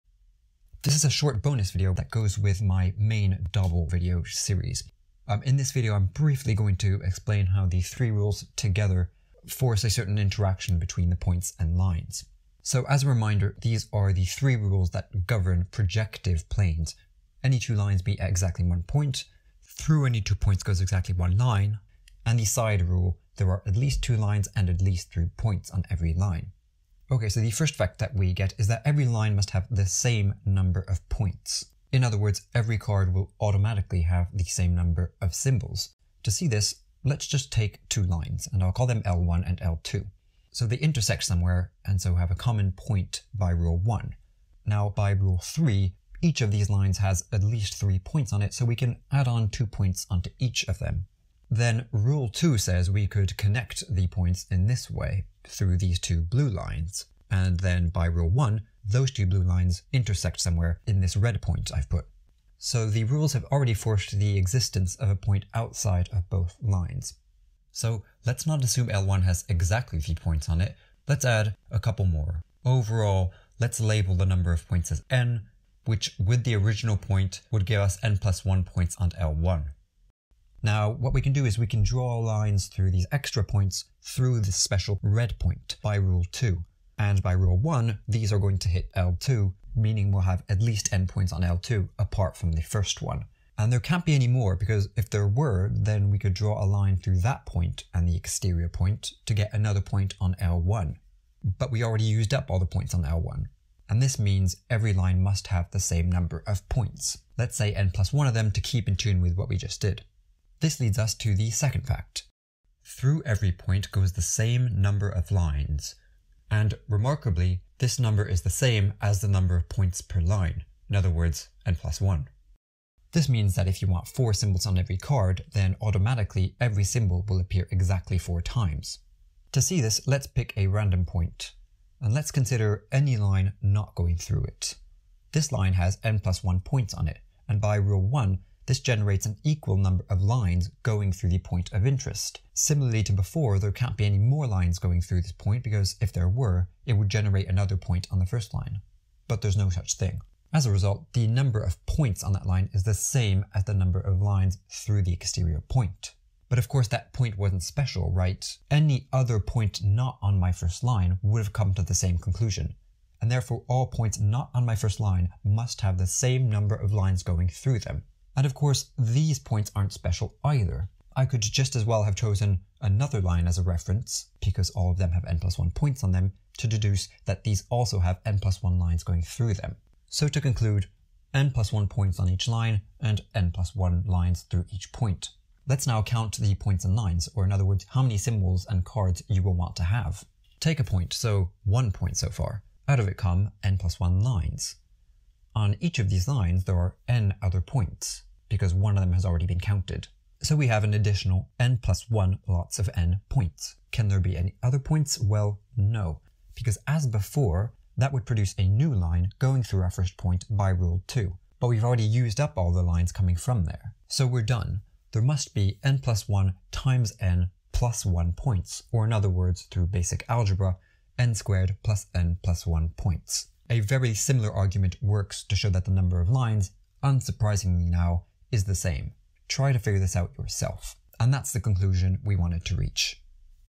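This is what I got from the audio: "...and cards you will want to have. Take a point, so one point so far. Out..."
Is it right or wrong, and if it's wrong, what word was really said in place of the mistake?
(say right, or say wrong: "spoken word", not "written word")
right.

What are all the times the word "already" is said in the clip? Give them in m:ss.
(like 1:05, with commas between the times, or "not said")
1:03, 1:41, 3:19, 3:31.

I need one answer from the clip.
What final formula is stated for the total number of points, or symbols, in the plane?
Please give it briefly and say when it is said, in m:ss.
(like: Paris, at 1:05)
n squared plus n plus 1, at 3:41.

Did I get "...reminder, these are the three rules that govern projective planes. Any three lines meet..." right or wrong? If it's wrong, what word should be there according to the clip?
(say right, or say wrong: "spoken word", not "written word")
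wrong: "two", not "three".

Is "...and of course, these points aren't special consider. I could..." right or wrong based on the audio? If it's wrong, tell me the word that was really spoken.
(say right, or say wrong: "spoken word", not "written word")
wrong: "either", not "consider".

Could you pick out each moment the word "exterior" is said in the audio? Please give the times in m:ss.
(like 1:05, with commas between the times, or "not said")
1:38, 2:35.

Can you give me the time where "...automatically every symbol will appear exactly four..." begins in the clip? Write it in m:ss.
2:05.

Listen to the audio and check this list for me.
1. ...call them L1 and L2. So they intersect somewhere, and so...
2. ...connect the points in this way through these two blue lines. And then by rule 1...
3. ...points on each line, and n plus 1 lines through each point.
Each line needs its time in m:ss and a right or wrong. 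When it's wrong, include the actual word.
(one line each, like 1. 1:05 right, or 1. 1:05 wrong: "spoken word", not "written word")
1. 0:38 right
2. 0:53 right
3. 3:01 right.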